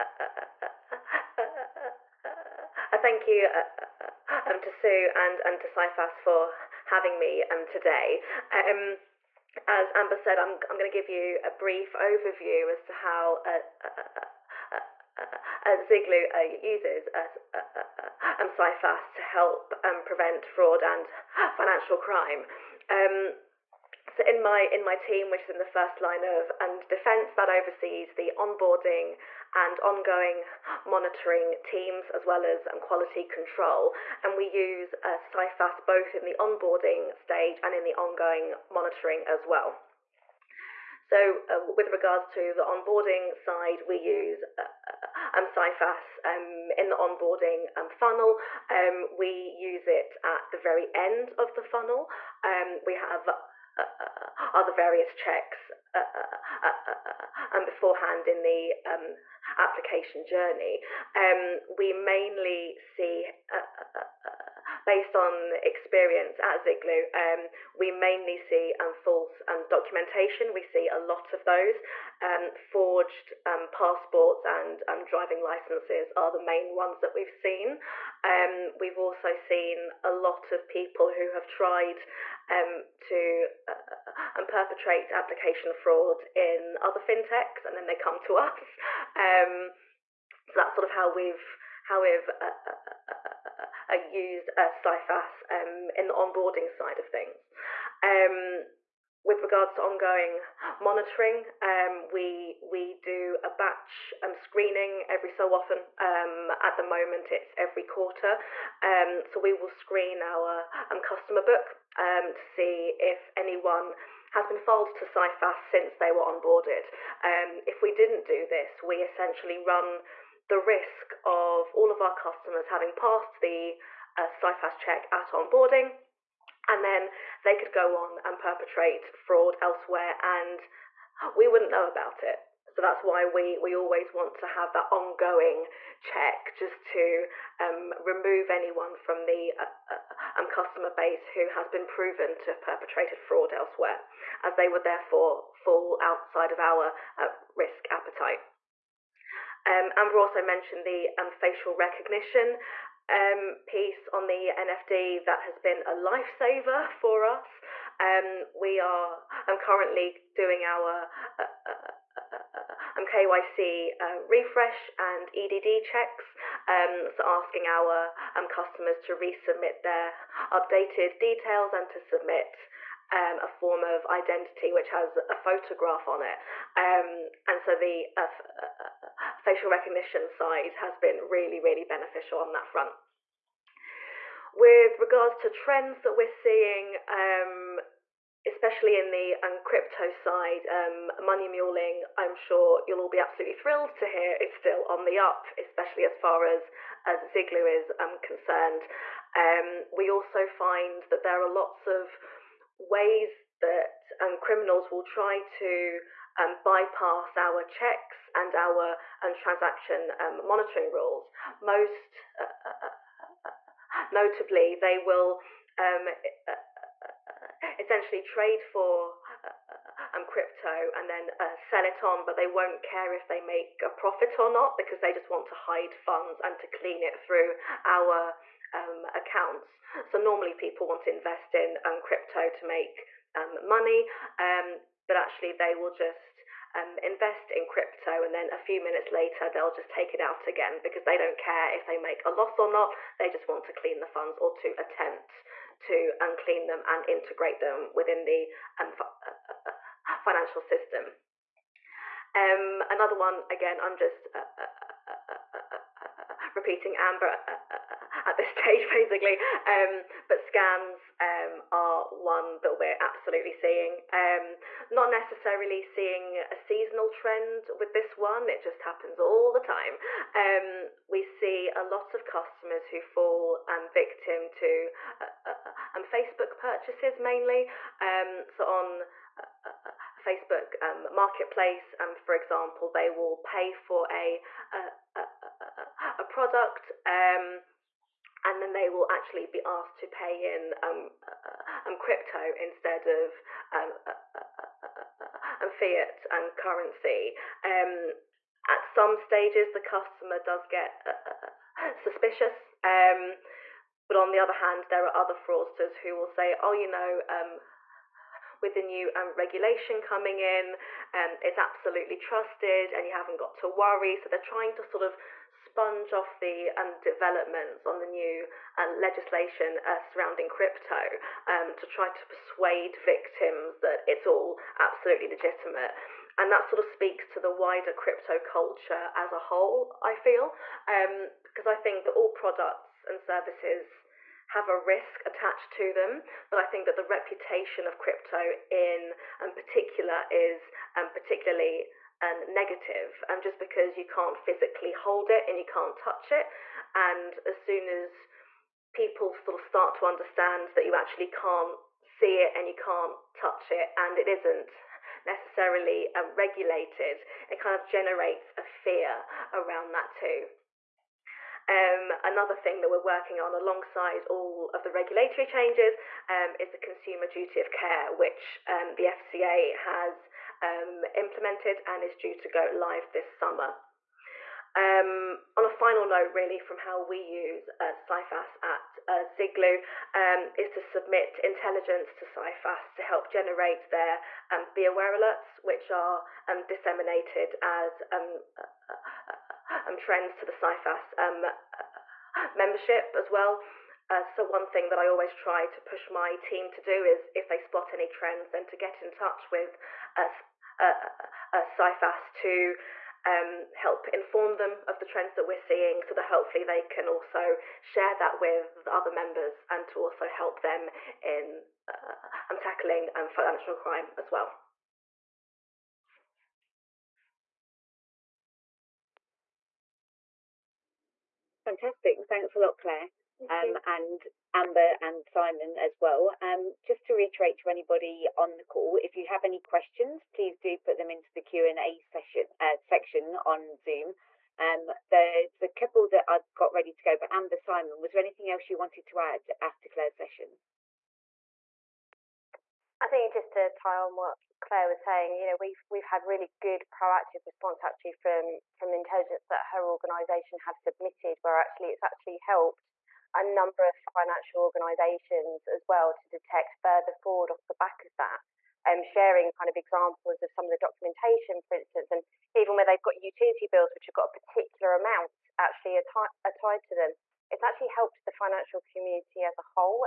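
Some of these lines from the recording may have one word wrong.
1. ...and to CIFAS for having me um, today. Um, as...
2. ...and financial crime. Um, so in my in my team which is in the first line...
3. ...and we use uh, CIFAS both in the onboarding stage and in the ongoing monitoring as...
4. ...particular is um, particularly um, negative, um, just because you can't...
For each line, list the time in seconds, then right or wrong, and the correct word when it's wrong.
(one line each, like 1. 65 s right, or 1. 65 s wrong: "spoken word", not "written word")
1. 5 s right
2. 20 s right
3. 34 s right
4. 339 s right.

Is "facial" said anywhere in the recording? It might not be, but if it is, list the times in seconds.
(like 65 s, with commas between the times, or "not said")
151 s, 179 s.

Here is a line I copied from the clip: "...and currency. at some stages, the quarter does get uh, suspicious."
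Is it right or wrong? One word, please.
wrong.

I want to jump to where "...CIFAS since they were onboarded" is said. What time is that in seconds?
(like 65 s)
115 s.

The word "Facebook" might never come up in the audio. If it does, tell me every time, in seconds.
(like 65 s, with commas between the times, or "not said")
276 s, 280 s.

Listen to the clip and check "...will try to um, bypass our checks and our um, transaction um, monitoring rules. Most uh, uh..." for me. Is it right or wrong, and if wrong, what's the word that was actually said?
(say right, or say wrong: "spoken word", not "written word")
right.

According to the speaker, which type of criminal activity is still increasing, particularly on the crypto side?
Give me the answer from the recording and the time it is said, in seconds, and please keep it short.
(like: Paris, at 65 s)
Money muling, at 191 s.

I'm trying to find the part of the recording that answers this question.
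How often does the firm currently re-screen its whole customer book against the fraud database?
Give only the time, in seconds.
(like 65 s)
107 s.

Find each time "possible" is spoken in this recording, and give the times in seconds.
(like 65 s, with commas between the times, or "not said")
not said.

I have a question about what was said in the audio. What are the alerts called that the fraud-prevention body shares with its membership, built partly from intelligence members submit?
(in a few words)
Be aware alerts.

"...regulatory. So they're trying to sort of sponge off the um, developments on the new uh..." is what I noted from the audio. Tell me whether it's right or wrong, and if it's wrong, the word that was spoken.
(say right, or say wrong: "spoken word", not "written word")
wrong: "worry", not "regulatory".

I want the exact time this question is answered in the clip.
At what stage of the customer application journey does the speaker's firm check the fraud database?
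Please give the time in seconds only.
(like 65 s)
50 s.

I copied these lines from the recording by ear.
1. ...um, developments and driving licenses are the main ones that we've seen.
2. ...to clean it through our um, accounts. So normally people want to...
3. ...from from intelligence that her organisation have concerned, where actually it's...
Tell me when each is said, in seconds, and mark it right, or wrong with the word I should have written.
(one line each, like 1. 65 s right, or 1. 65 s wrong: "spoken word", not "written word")
1. 73 s wrong: "passports", not "developments"
2. 226 s right
3. 448 s wrong: "submitted", not "concerned".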